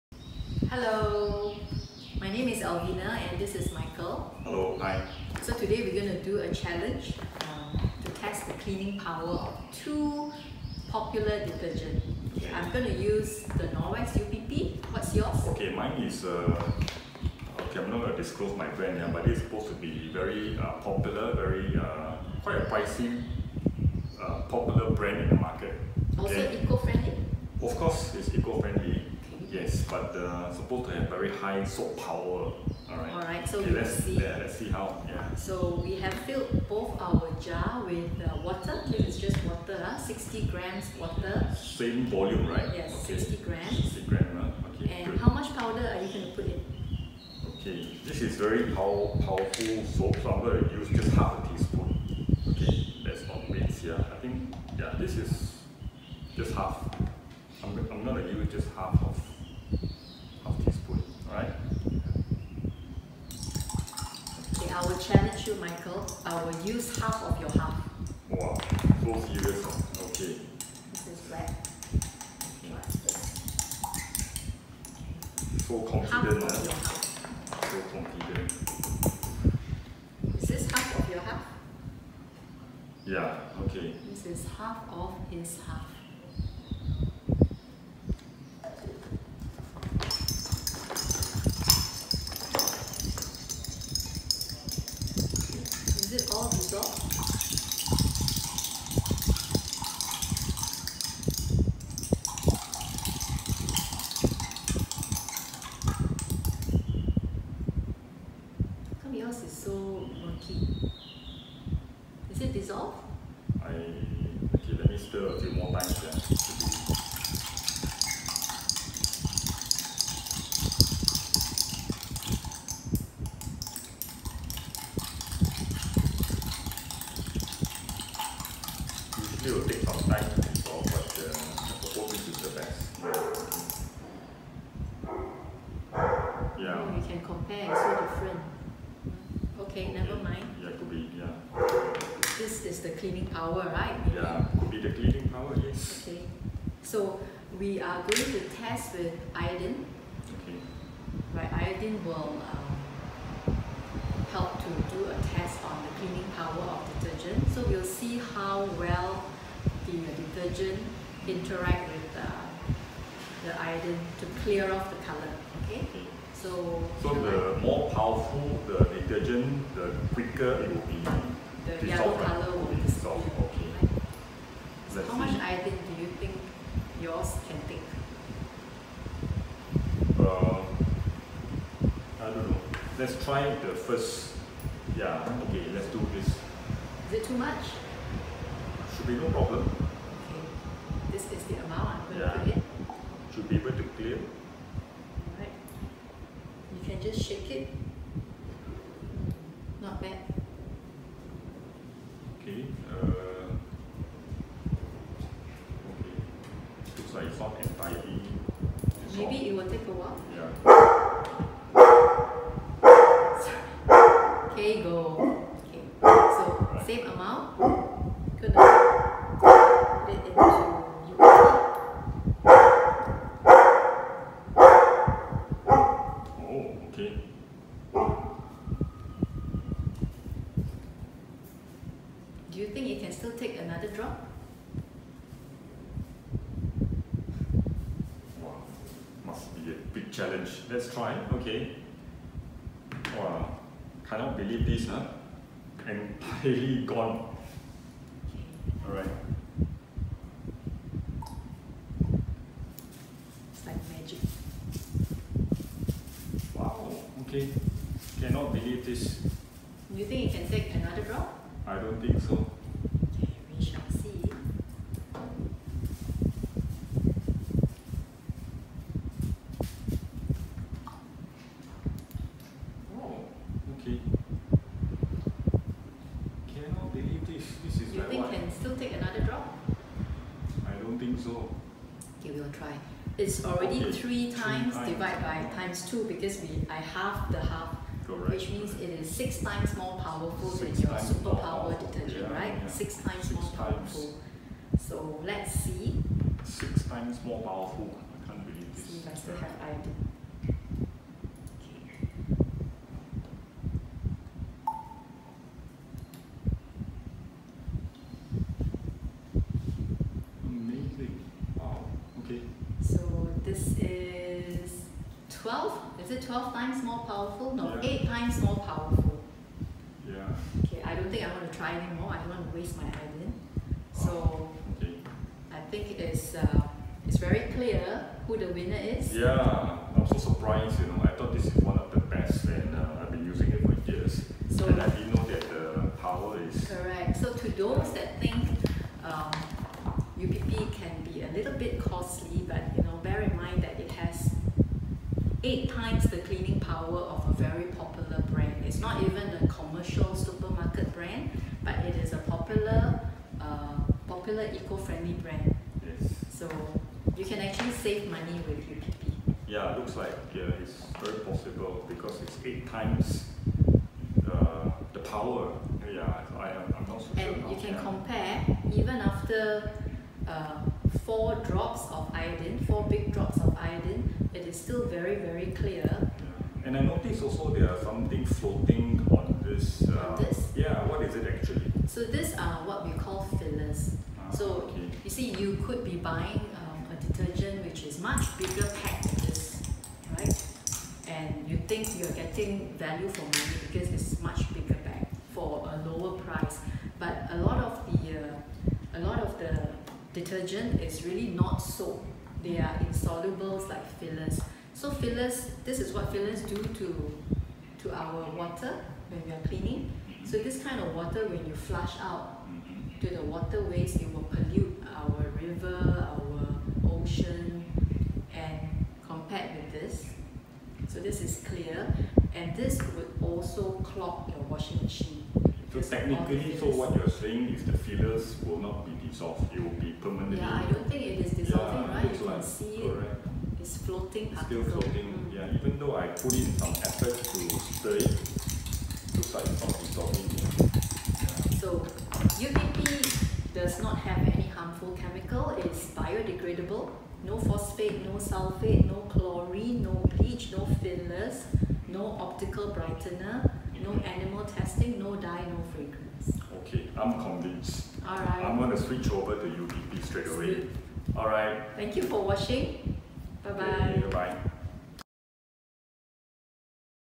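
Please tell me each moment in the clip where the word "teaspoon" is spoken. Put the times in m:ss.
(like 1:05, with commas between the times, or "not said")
0:51, 1:00.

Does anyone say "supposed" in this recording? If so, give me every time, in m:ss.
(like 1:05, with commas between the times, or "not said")
0:19, 0:30.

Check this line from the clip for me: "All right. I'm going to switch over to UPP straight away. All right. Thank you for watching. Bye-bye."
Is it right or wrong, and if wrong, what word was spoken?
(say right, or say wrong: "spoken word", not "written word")
right.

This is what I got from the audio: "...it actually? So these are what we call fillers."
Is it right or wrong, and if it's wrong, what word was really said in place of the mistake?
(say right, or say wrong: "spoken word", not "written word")
right.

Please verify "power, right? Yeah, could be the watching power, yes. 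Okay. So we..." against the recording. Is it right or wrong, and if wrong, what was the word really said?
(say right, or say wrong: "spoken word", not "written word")
wrong: "cleaning", not "watching".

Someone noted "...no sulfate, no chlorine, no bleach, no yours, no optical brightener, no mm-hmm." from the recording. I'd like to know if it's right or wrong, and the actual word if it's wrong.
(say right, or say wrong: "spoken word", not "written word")
wrong: "fillers", not "yours".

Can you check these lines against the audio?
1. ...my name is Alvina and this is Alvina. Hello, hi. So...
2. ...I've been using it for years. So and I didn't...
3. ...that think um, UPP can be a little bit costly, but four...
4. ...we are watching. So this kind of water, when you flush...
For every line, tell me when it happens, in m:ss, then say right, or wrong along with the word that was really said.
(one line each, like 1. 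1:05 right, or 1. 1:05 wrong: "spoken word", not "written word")
1. 0:02 wrong: "Michael", not "Alvina"
2. 5:33 right
3. 5:37 wrong: "eight", not "four"
4. 6:49 wrong: "cleaning", not "watching".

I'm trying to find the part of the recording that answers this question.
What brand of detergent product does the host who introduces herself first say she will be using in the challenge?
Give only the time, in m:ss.
0:13.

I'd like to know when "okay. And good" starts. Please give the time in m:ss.
0:44.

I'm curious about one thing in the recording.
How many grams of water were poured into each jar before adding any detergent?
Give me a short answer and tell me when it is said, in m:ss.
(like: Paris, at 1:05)
60 grams, at 0:39.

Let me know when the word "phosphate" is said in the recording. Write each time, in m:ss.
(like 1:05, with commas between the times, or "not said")
7:27.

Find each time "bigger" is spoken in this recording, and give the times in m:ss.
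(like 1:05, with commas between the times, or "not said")
6:28, 6:34.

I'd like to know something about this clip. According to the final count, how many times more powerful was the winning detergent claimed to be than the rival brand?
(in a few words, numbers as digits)
8 times.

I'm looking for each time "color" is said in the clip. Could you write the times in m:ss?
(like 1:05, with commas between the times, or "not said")
2:45, 2:52.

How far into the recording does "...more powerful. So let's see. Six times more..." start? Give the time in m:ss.
4:53.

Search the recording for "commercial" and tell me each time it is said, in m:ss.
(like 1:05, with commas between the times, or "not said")
5:49.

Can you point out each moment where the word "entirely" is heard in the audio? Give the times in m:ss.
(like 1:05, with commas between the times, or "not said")
3:27, 4:05.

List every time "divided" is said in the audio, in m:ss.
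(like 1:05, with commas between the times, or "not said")
4:44.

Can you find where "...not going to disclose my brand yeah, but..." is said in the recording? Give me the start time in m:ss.
0:17.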